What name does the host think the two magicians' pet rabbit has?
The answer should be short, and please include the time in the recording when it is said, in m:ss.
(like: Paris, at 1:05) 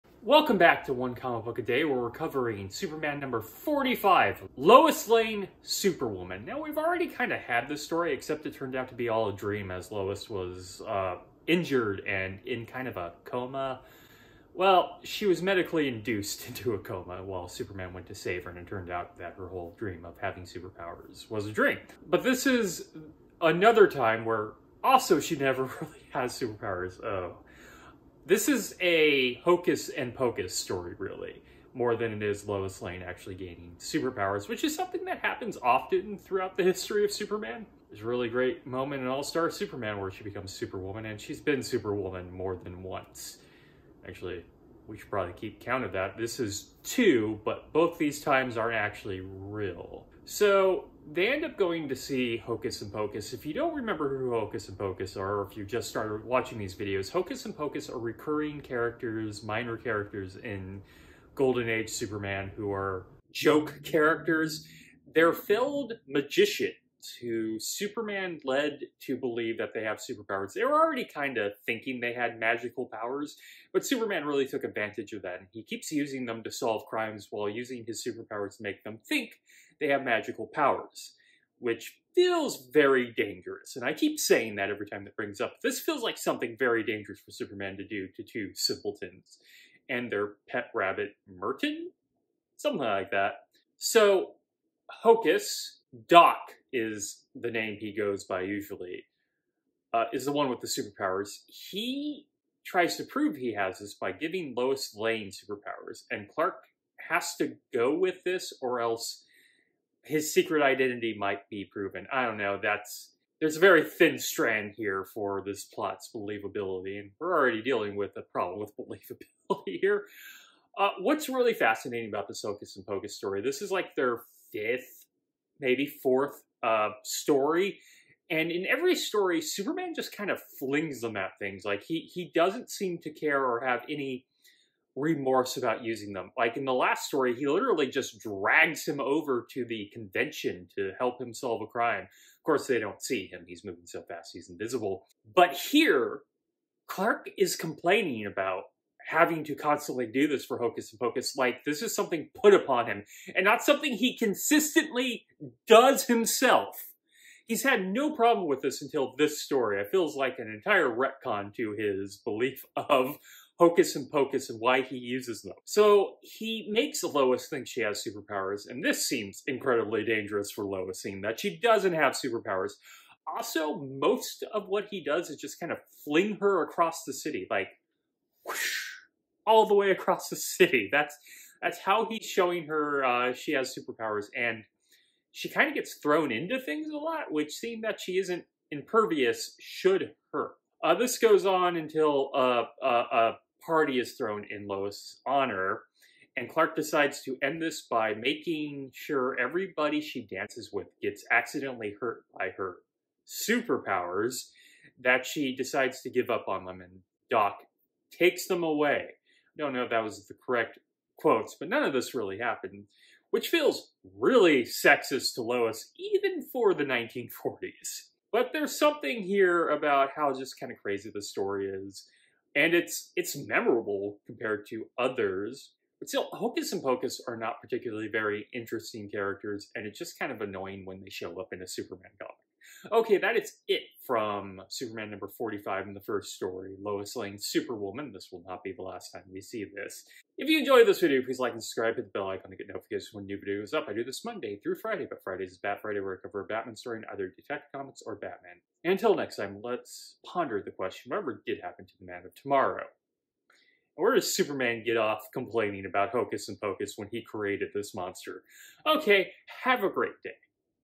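Merton, at 1:31.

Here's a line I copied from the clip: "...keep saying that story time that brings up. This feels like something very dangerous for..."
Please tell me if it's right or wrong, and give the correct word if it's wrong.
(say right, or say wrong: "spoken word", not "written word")
wrong: "every", not "story".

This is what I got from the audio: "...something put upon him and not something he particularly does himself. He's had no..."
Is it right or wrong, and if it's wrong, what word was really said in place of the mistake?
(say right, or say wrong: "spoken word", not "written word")
wrong: "consistently", not "particularly".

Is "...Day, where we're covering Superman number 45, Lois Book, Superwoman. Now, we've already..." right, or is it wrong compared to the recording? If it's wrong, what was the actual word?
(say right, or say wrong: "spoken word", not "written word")
wrong: "Lane", not "Book".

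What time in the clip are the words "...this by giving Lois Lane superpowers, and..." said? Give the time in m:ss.
1:43.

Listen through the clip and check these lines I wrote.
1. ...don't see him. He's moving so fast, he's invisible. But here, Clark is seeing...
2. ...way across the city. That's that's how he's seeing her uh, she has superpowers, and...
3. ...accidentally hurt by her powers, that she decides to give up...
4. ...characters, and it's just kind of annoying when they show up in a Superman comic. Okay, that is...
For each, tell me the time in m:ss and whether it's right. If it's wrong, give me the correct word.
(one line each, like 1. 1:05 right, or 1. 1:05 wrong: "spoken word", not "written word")
1. 2:22 wrong: "complaining", not "seeing"
2. 2:59 wrong: "showing", not "seeing"
3. 3:21 wrong: "superpowers", not "powers"
4. 3:49 right.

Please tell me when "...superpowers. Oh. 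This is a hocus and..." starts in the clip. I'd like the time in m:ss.
0:26.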